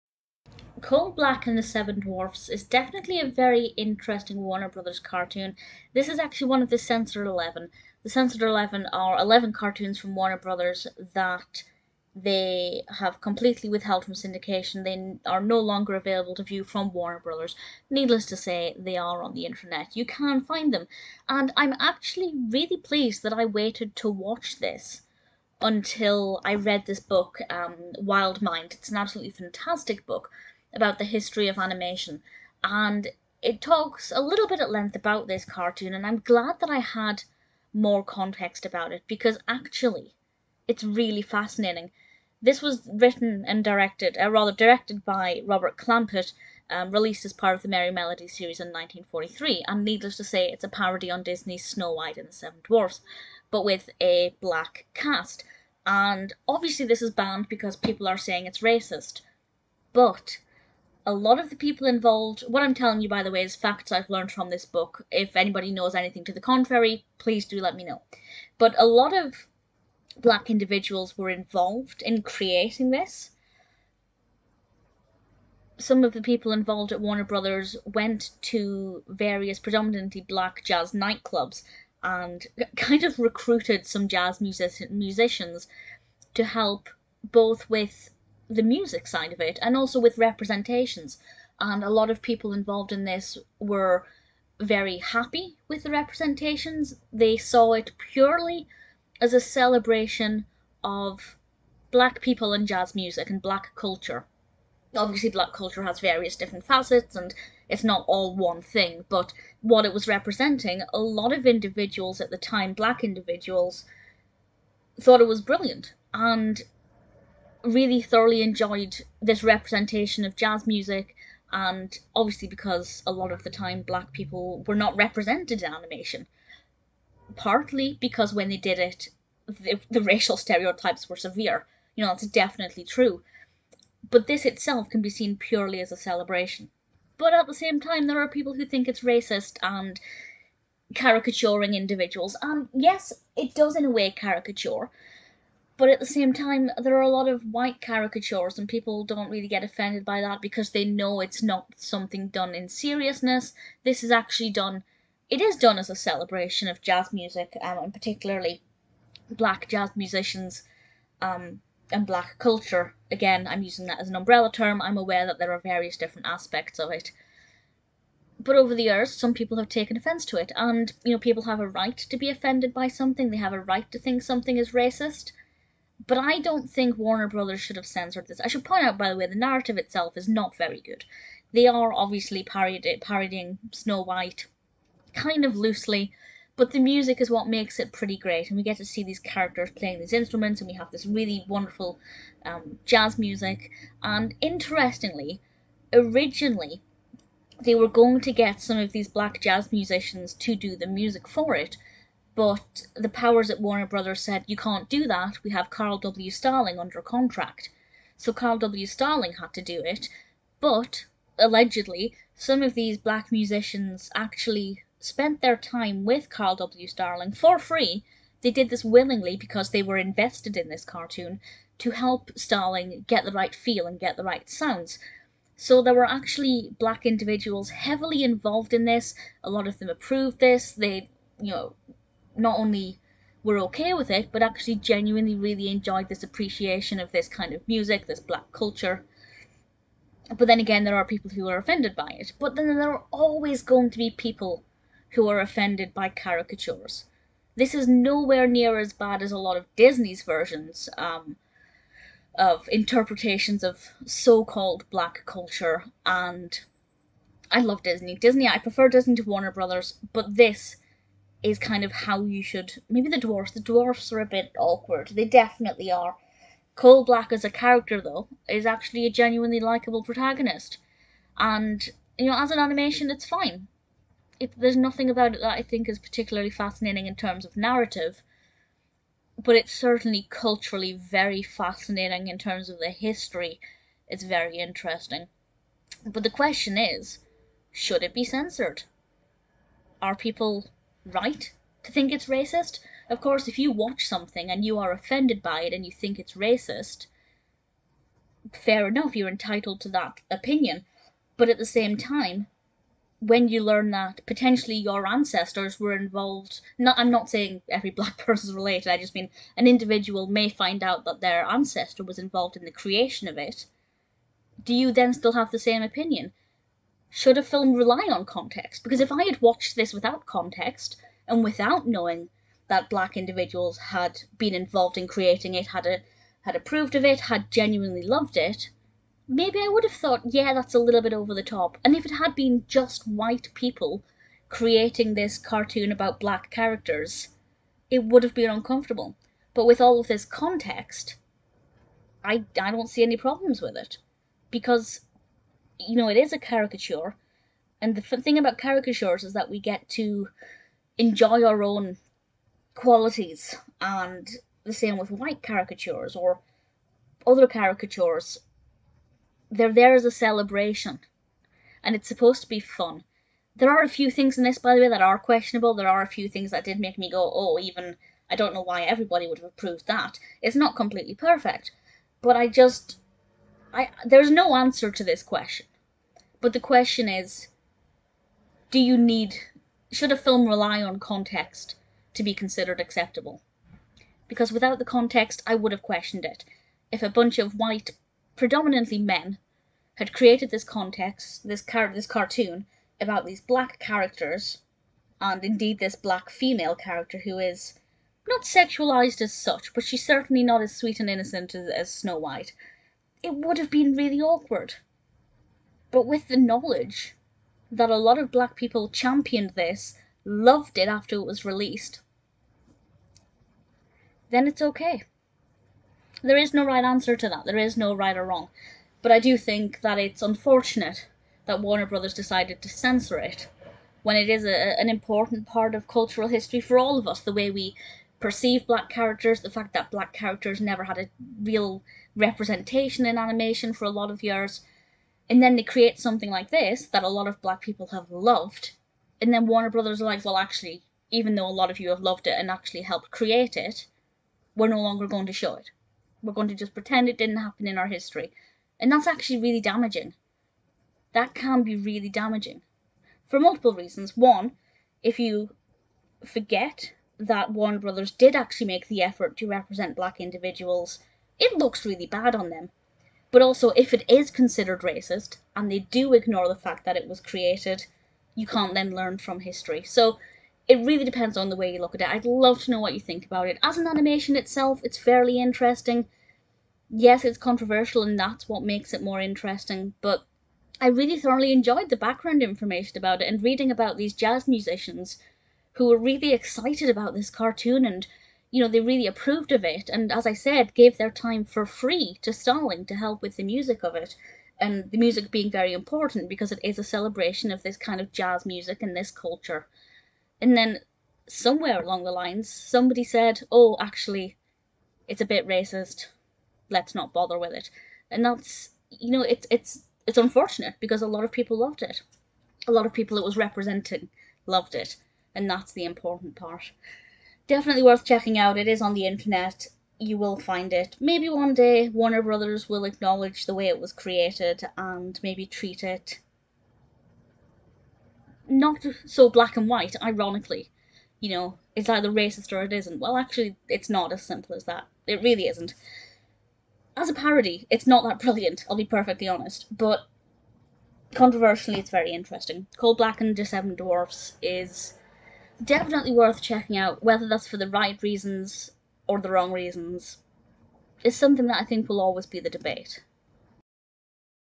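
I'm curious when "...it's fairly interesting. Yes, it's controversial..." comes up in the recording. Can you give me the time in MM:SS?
07:54.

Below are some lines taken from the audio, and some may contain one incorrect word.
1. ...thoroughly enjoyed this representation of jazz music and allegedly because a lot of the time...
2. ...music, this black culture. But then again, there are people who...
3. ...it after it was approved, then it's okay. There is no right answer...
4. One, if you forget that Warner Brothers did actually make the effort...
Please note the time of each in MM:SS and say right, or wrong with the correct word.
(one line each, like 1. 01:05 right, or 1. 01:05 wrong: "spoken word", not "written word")
1. 01:58 wrong: "obviously", not "allegedly"
2. 03:57 right
3. 06:50 wrong: "released", not "approved"
4. 07:34 right.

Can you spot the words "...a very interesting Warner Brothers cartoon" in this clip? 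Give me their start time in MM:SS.
00:03.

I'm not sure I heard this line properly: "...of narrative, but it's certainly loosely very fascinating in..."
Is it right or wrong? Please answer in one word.
wrong.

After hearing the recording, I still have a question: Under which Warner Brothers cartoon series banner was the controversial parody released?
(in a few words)
Merrie Melody.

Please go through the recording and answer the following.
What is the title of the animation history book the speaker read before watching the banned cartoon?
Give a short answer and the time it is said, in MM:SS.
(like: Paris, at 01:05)
Wild Mind, at 00:27.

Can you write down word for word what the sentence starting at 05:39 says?
But with all of this context, I, I don't see any problems with it.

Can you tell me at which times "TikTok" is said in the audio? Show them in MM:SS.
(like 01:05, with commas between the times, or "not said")
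not said.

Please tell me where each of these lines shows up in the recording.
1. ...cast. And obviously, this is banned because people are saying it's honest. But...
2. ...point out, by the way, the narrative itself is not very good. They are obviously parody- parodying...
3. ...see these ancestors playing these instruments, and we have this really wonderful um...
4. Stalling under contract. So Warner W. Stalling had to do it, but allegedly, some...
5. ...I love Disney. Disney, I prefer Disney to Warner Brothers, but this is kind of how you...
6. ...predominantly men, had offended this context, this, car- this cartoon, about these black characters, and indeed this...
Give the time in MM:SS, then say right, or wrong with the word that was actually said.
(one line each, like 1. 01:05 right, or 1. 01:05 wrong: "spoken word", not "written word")
1. 00:54 wrong: "racist", not "honest"
2. 02:58 right
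3. 03:08 wrong: "characters", not "ancestors"
4. 03:26 wrong: "Carl", not "Warner"
5. 04:17 right
6. 06:28 wrong: "created", not "offended".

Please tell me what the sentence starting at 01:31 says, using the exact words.
And a lot of people involved in this were very happy with the representations.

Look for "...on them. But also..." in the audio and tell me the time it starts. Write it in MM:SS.
07:42.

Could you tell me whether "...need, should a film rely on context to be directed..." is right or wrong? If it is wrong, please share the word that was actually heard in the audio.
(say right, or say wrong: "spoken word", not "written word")
wrong: "considered", not "directed".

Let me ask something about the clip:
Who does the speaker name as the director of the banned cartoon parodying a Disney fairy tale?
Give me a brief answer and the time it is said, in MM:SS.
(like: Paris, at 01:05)
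Robert Clampett, at 00:45.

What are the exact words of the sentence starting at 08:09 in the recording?
And as I said, gave their time for free to Stalling to help with the music of it.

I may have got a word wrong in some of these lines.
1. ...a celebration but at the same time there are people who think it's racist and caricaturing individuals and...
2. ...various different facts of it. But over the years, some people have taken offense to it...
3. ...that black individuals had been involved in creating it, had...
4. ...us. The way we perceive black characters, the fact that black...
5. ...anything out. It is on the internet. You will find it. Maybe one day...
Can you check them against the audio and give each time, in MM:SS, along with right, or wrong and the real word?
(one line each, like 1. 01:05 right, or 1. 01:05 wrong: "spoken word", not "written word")
1. 02:15 right
2. 02:45 wrong: "aspects", not "facts"
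3. 05:22 right
4. 07:07 right
5. 08:38 wrong: "checking", not "anything".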